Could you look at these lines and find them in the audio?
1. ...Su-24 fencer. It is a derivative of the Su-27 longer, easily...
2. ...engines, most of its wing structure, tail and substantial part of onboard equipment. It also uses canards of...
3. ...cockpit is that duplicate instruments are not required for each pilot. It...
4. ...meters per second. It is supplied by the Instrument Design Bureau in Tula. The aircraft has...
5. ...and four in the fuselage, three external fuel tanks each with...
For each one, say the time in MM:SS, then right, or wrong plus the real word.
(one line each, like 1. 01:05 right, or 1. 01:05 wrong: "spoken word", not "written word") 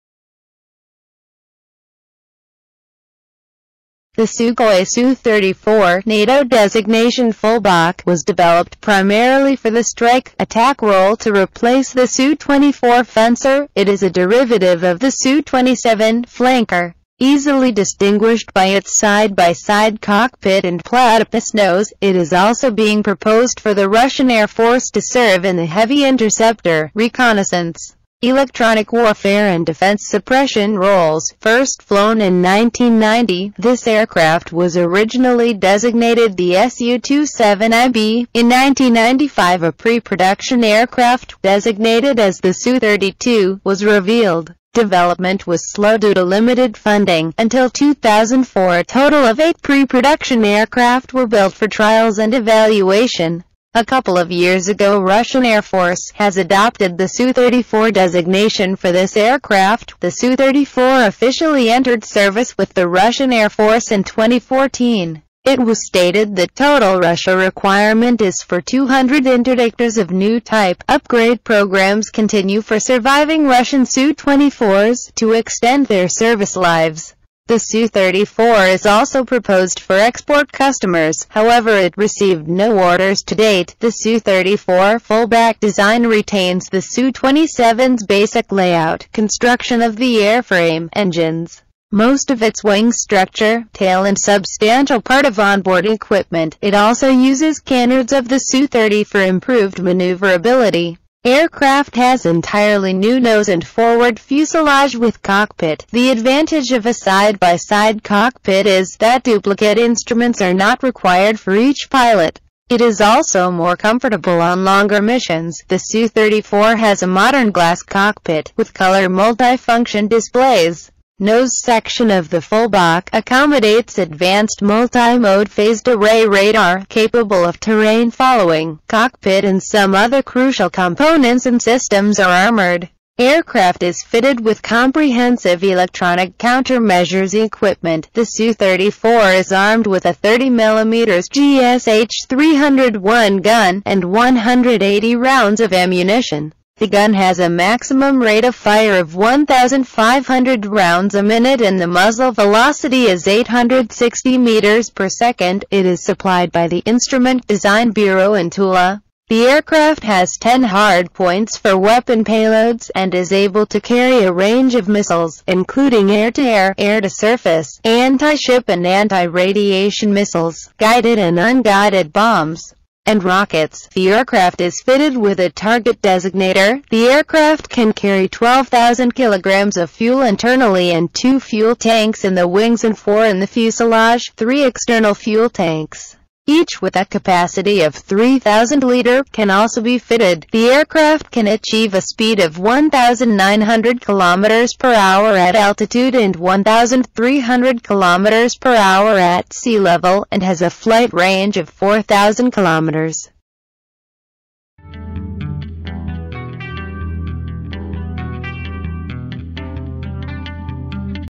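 1. 00:12 wrong: "flanker", not "longer"
2. 01:30 right
3. 01:48 right
4. 02:34 right
5. 03:02 right.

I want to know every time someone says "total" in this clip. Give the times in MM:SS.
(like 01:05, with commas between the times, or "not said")
00:48, 01:06.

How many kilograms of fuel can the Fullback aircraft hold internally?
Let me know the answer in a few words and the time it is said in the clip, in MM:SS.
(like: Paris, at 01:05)
12,000 kilograms, at 02:58.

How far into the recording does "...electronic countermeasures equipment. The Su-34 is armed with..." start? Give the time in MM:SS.
02:15.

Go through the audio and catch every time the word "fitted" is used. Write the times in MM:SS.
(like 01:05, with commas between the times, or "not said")
02:14, 02:54, 03:09.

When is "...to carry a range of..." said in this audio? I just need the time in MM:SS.
02:43.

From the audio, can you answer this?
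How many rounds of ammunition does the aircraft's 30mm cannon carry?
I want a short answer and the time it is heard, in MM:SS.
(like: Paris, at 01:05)
180, at 02:24.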